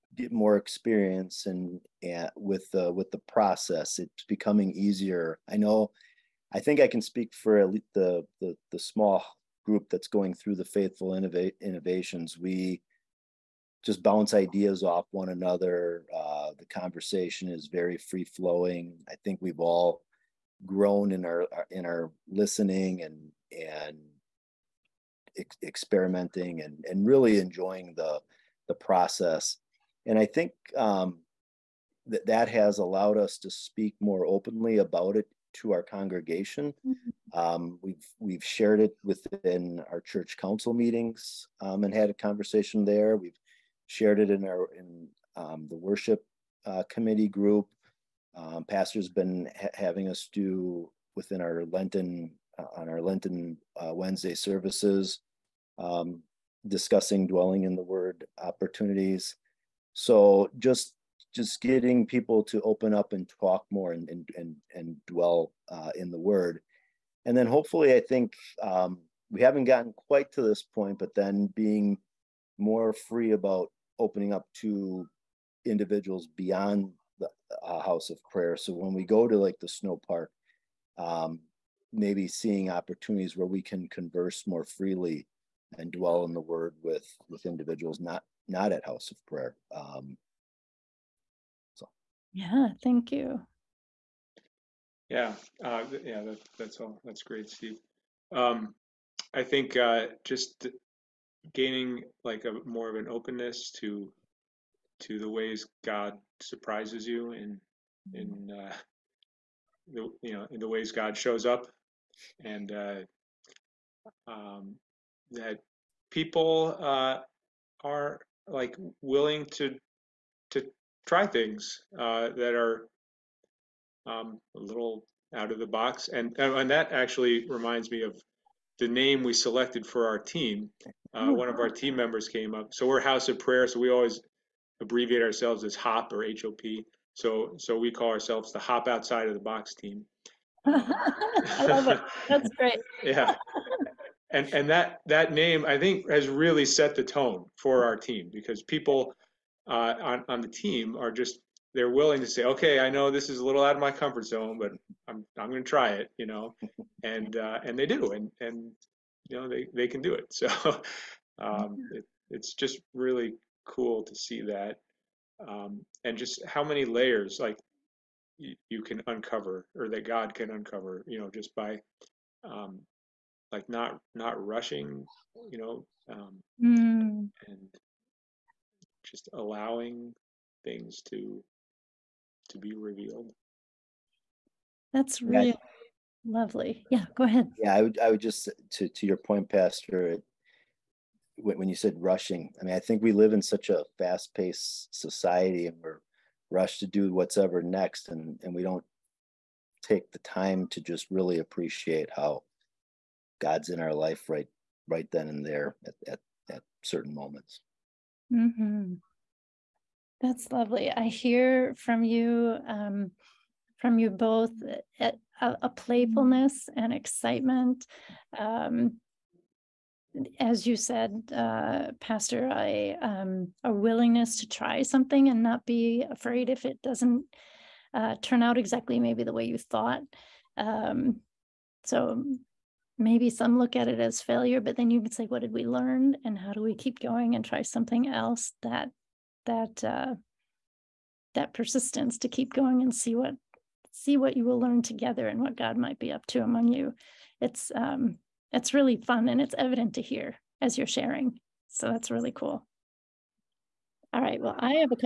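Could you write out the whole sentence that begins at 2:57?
and just allowing things to to be revealed.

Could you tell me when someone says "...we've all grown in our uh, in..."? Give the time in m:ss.
0:19.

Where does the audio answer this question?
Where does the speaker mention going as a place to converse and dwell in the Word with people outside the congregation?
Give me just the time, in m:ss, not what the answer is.
1:19.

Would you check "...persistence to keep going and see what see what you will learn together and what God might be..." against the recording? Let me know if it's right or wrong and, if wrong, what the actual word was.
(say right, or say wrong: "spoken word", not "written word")
right.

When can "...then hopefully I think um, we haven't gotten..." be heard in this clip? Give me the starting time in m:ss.
1:07.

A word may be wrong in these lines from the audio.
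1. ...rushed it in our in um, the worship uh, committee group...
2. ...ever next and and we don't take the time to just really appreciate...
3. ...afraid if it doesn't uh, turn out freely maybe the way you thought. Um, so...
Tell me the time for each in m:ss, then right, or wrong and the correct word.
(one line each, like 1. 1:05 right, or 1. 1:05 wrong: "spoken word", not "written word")
1. 0:43 wrong: "shared", not "rushed"
2. 3:17 right
3. 3:46 wrong: "exactly", not "freely".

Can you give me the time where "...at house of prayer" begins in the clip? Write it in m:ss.
1:28.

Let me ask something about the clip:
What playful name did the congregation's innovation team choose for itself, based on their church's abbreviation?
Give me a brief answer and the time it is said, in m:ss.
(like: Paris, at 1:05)
Hop Outside of the Box team, at 2:18.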